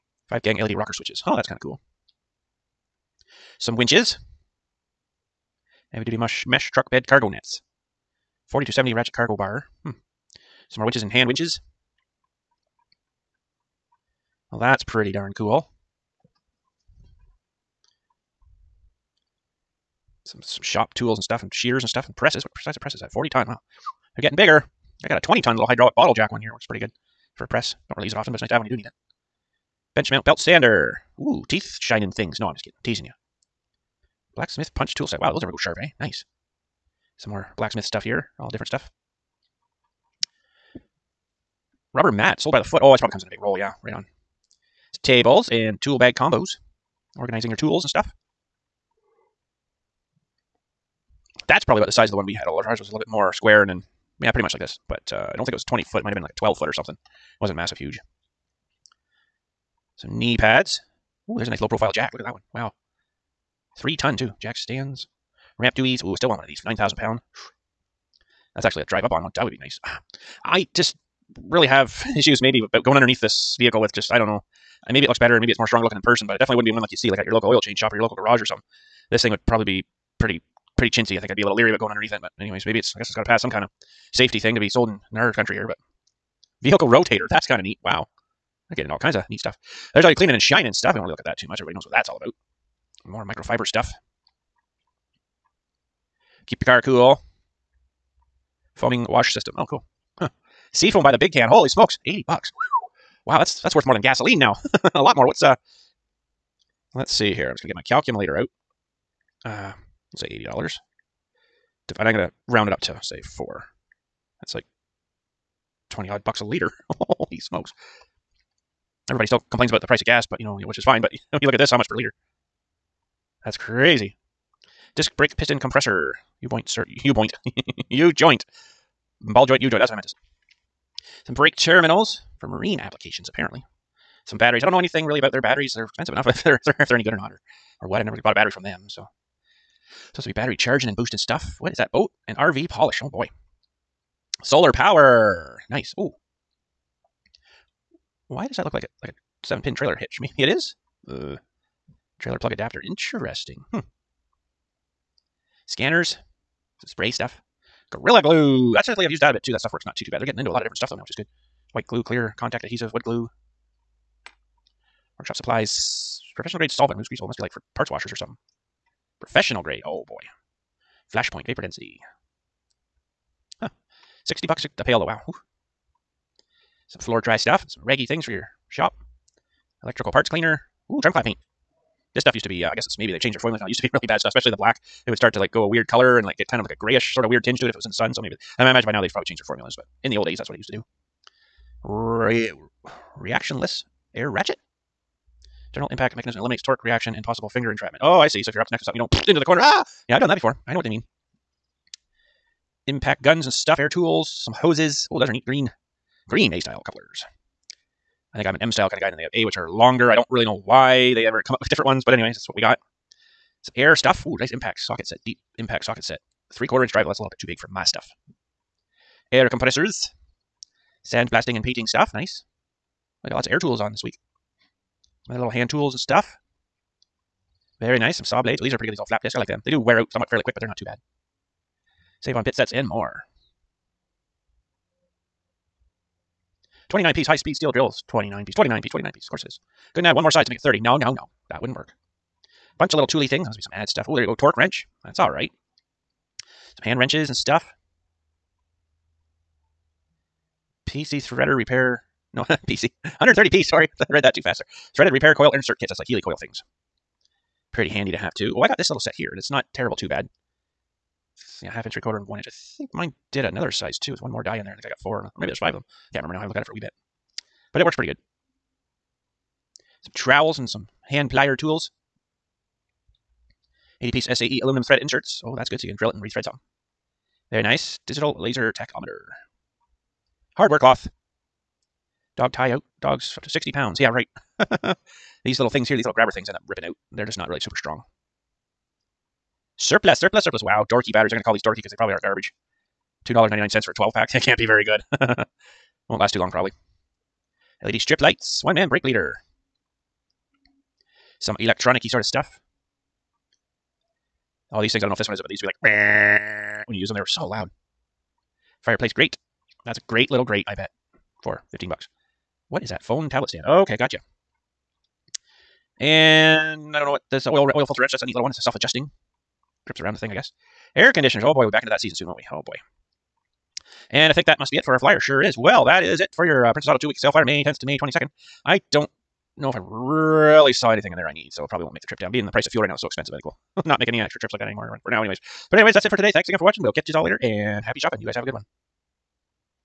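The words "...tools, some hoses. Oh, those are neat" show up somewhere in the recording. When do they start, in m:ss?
3:23.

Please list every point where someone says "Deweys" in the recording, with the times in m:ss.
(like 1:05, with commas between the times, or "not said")
1:05.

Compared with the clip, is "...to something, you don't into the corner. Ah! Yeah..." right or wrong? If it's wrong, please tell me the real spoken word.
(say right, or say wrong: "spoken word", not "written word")
right.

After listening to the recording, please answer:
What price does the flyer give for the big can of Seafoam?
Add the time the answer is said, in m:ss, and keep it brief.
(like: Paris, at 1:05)
$80, at 1:42.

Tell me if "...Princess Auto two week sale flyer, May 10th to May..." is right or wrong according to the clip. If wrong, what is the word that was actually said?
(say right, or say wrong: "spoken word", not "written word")
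right.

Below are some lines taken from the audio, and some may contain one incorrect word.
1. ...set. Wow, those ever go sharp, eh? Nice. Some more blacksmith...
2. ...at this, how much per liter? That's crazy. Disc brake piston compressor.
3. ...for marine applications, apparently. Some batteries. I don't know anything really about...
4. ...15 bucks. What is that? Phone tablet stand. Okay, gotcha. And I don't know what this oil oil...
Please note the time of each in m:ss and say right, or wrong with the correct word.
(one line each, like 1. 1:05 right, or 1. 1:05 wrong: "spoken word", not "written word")
1. 0:35 right
2. 2:01 right
3. 2:12 right
4. 5:11 right.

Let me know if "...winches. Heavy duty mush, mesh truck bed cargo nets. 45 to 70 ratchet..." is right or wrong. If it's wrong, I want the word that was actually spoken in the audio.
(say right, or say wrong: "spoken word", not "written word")
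wrong: "40", not "45".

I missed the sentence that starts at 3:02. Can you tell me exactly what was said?
This stuff used to be, uh, I guess it's maybe they've changed their formulas now.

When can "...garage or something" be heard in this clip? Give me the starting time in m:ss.
1:18.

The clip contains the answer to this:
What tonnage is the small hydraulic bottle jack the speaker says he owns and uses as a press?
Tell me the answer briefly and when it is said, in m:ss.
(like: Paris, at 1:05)
20 ton, at 0:25.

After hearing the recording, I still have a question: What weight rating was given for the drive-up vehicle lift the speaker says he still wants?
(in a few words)
9000 pound.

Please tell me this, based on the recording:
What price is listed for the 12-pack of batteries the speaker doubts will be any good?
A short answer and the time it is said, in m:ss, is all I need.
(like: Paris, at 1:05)
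$2.99, at 4:53.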